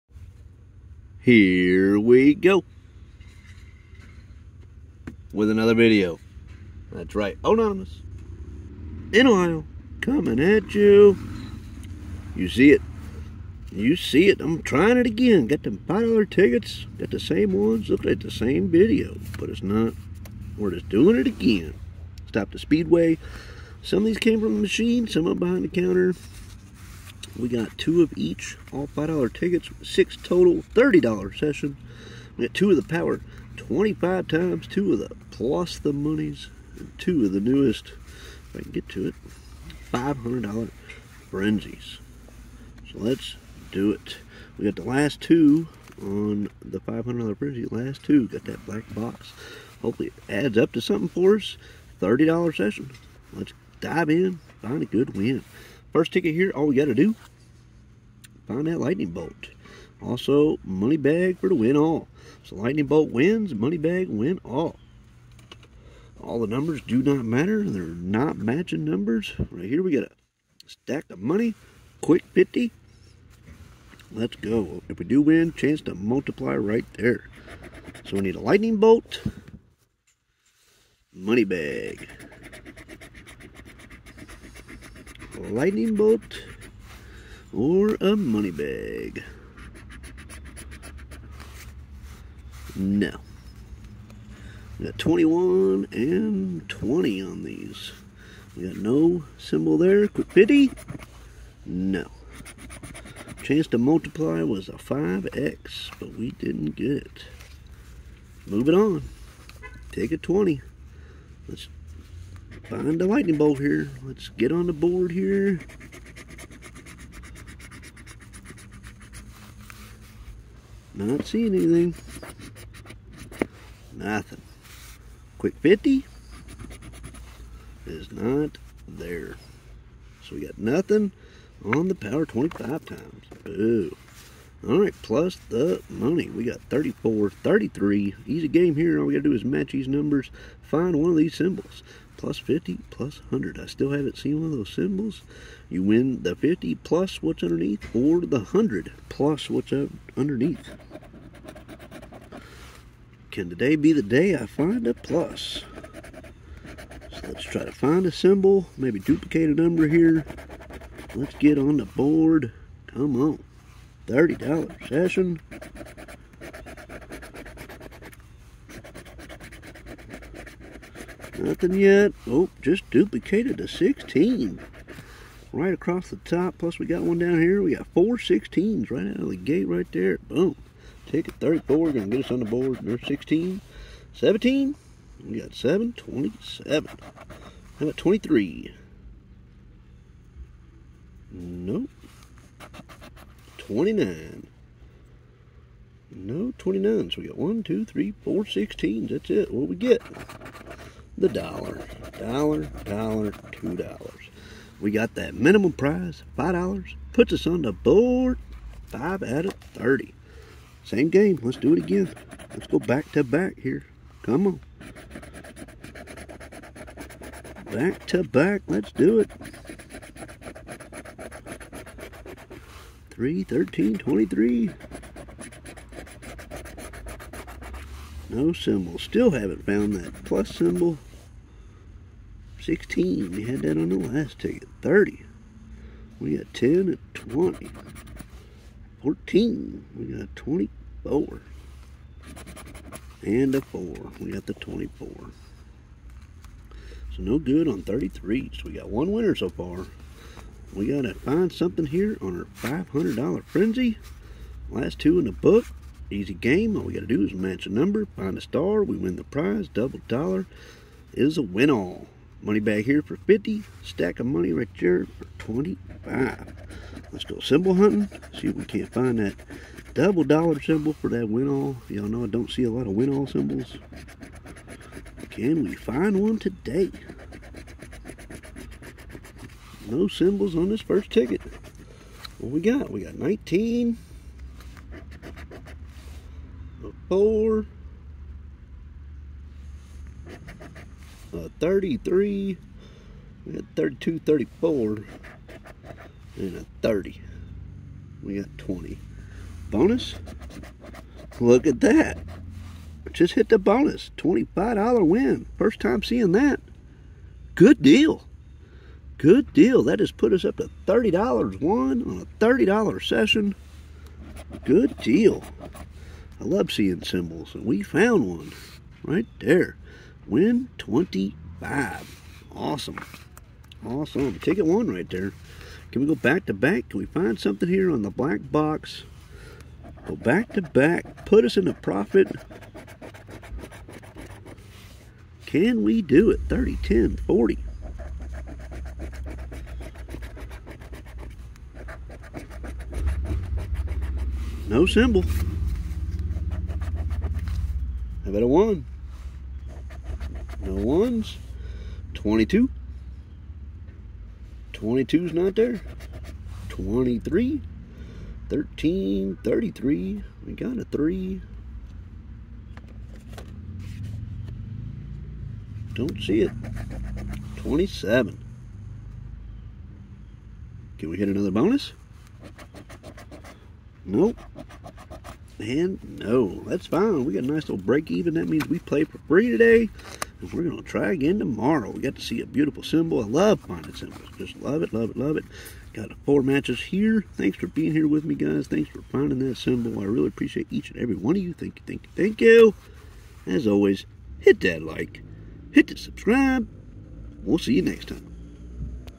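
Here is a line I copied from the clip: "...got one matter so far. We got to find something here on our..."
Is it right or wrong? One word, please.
wrong.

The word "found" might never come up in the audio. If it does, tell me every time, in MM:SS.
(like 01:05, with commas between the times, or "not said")
03:49, 05:17.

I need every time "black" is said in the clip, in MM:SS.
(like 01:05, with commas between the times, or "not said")
00:48, 05:28.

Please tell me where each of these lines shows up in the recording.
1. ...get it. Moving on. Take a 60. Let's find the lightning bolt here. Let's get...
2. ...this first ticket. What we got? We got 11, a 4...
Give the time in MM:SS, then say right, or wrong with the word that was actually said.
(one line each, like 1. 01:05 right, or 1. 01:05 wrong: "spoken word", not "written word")
1. 01:46 wrong: "20", not "60"
2. 04:40 wrong: "19", not "11".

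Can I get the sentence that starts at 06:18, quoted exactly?
That means we play for free today because we're going to try again tomorrow.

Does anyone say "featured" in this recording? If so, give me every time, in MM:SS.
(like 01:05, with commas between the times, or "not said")
not said.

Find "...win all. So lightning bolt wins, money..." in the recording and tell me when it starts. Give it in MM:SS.
01:01.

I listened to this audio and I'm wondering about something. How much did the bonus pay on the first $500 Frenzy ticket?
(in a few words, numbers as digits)
$25.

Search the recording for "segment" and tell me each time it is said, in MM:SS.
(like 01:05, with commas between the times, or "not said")
not said.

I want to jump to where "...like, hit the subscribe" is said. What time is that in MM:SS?
06:34.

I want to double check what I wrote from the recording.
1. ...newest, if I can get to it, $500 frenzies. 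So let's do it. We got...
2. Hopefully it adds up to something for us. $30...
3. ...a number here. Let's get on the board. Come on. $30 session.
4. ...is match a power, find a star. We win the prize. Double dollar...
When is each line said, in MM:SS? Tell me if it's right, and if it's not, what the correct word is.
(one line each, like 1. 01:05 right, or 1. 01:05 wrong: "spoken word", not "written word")
1. 00:37 right
2. 00:49 right
3. 02:39 right
4. 04:17 wrong: "number", not "power".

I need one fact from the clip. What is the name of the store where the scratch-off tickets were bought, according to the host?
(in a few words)
Speedway.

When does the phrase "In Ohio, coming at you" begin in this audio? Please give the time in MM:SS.
00:09.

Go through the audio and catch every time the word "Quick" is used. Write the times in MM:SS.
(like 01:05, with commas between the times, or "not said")
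01:12, 01:40, 02:05.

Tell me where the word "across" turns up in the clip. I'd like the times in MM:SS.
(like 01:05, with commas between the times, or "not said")
02:55.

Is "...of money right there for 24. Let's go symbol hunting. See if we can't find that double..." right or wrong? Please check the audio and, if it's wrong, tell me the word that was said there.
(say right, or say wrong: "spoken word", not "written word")
wrong: "25", not "24".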